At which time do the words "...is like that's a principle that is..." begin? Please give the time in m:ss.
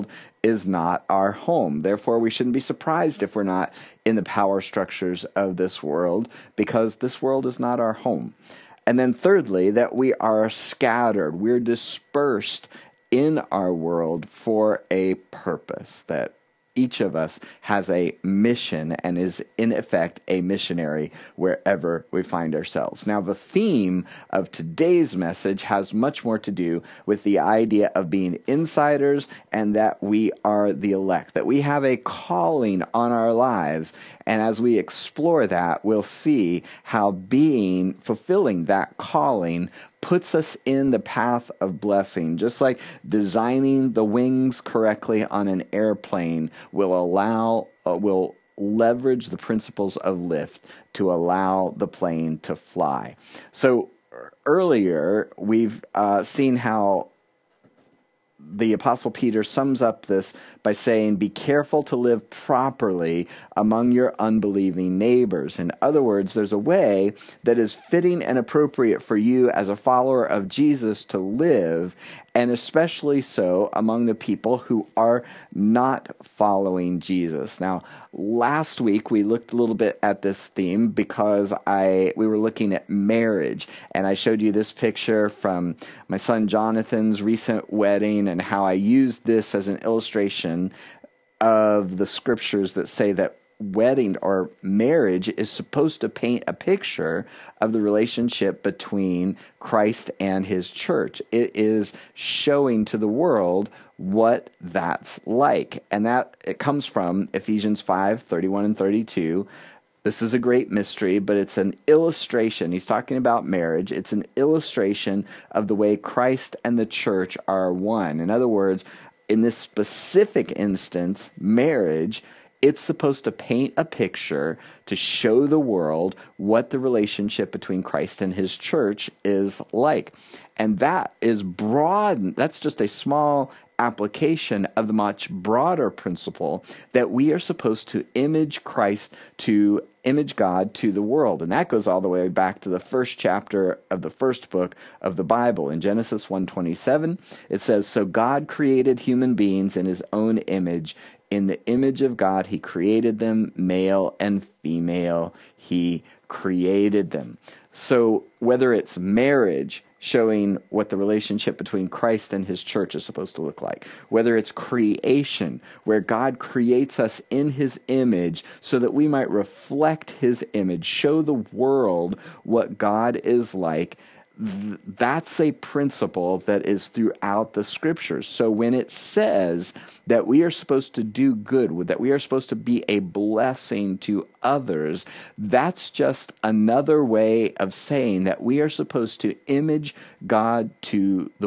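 2:53.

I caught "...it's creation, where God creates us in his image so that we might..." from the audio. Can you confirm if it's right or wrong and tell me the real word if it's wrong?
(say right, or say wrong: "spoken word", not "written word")
right.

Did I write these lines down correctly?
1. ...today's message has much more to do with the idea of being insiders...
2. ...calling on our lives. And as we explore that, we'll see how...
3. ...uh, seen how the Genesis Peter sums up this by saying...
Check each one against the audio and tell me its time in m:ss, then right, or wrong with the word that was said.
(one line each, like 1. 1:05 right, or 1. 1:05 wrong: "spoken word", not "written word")
1. 0:24 right
2. 0:31 right
3. 0:55 wrong: "Apostle", not "Genesis".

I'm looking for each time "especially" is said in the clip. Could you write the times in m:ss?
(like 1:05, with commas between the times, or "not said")
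1:12.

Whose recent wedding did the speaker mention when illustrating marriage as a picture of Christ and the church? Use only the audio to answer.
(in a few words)
Jonathan.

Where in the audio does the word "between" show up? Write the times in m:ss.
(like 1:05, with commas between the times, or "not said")
1:38, 2:07, 2:41.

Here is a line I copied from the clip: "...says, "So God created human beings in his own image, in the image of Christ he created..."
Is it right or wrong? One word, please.
wrong.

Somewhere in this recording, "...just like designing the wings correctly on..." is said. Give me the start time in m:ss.
0:42.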